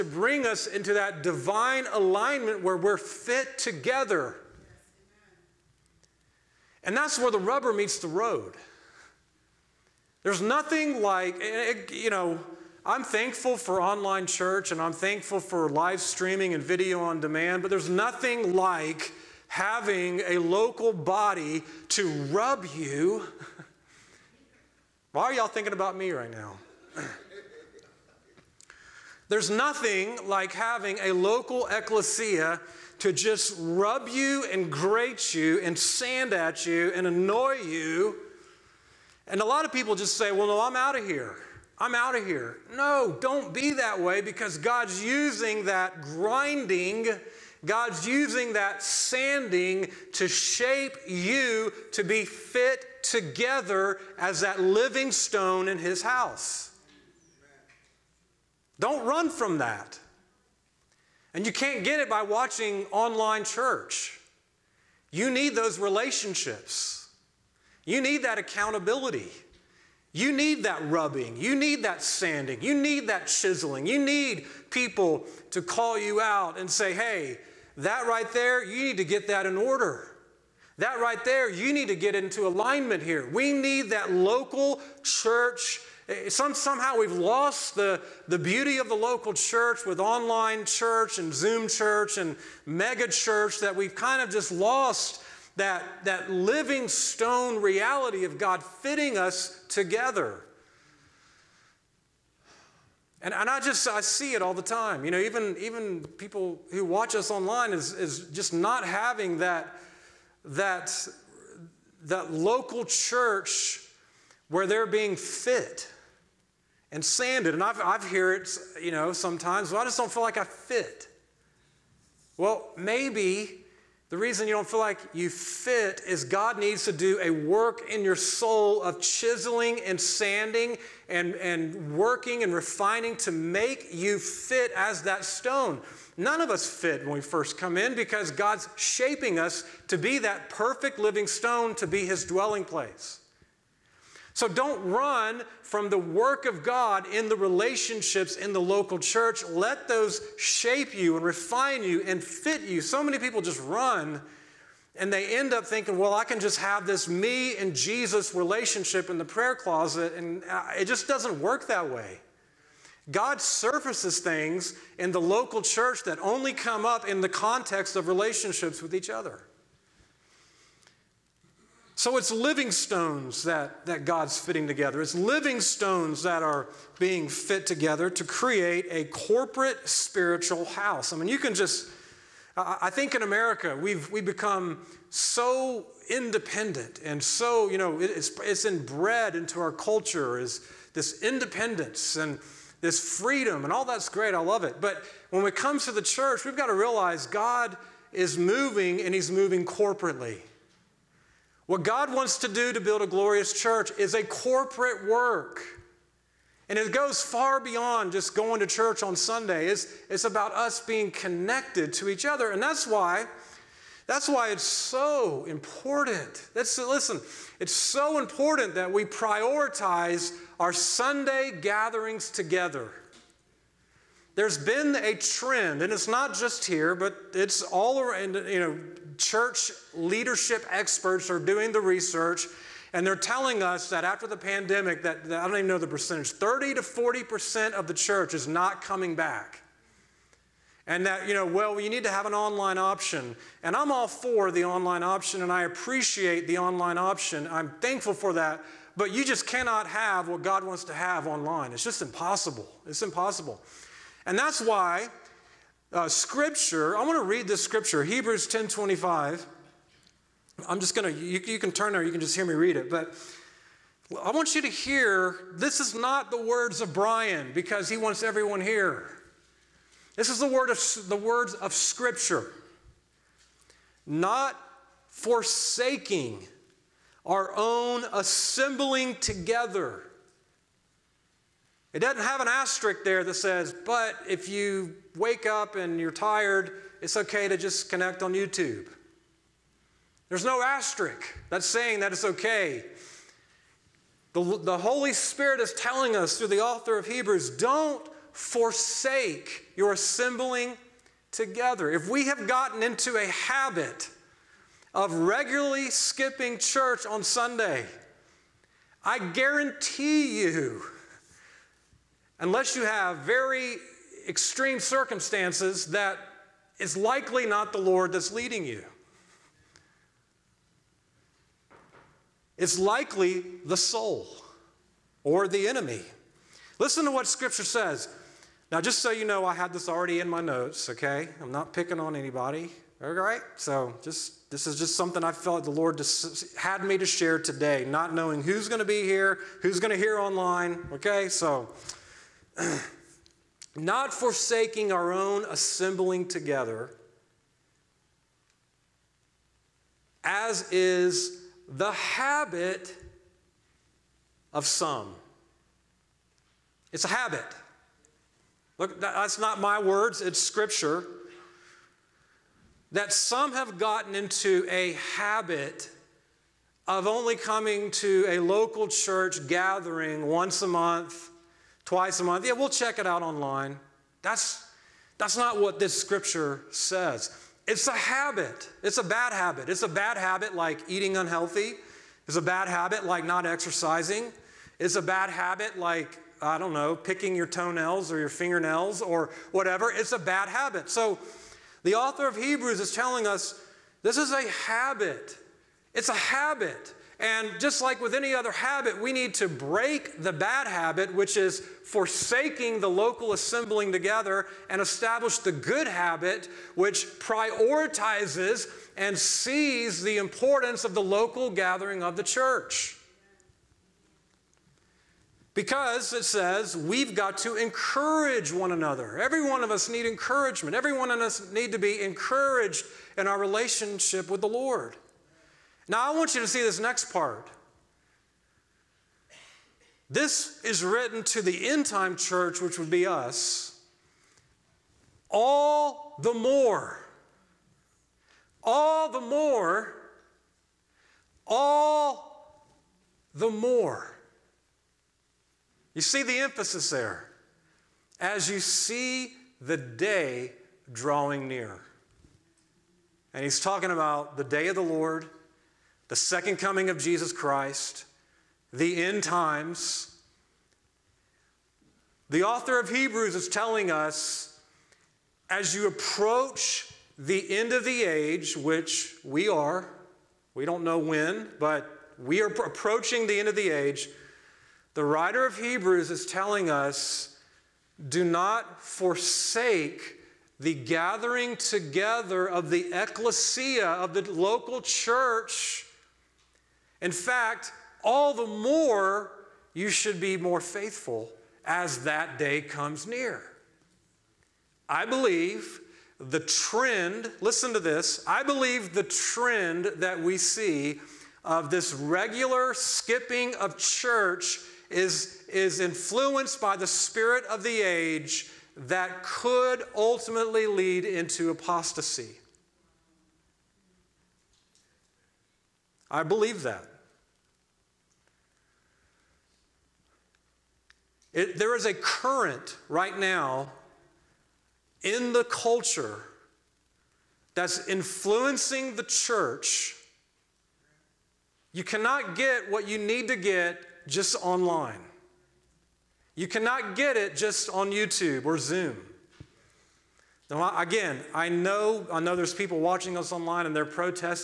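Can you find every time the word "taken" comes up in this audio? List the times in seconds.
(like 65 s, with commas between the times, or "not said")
not said.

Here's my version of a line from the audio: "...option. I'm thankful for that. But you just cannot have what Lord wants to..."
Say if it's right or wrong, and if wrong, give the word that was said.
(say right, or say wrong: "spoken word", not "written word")
wrong: "God", not "Lord".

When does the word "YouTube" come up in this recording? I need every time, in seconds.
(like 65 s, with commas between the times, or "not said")
288 s, 537 s.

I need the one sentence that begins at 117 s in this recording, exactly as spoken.
And I've, I've heard it, you know, sometimes, well, I just don't feel like I fit.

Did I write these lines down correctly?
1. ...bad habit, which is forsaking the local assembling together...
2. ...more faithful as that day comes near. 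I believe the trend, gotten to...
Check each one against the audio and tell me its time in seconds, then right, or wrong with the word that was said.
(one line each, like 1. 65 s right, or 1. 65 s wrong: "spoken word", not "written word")
1. 400 s right
2. 490 s wrong: "listen", not "gotten".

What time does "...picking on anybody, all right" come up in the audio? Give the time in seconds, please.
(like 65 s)
331 s.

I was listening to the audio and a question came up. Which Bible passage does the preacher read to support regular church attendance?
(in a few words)
Hebrews 10:25.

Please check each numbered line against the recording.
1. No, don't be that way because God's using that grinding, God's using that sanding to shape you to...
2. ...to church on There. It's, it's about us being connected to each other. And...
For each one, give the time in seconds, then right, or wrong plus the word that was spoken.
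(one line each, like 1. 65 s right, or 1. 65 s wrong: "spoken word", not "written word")
1. 42 s right
2. 208 s wrong: "Sunday", not "There".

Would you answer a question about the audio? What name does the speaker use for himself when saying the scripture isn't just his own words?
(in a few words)
Bryan.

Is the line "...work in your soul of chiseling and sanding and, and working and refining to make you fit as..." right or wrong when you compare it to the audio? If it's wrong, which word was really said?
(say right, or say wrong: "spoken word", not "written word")
right.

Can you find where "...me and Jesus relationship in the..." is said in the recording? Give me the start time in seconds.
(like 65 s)
157 s.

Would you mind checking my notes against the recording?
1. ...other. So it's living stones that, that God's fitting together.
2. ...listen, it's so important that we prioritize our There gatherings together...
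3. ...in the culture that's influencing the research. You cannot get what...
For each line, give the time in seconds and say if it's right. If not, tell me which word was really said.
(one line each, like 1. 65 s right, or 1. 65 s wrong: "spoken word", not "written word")
1. 169 s right
2. 216 s wrong: "Sunday", not "There"
3. 525 s wrong: "church", not "research".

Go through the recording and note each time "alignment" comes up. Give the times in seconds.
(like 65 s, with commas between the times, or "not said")
1 s, 82 s.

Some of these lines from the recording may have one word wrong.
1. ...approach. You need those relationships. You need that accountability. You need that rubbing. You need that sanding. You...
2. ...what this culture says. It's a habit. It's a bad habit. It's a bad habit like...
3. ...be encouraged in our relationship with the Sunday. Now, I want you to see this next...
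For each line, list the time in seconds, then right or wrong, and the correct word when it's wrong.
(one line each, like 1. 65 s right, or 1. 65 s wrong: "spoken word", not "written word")
1. 63 s wrong: "church", not "approach"
2. 375 s wrong: "scripture", not "culture"
3. 421 s wrong: "Lord", not "Sunday".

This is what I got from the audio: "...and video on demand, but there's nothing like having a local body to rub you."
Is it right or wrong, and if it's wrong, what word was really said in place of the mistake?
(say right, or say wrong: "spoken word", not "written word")
right.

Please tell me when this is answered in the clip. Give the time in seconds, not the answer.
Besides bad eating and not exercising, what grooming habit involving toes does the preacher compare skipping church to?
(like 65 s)
386 s.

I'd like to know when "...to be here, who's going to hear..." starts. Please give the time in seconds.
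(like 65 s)
338 s.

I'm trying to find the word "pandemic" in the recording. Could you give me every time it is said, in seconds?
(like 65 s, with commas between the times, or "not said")
234 s.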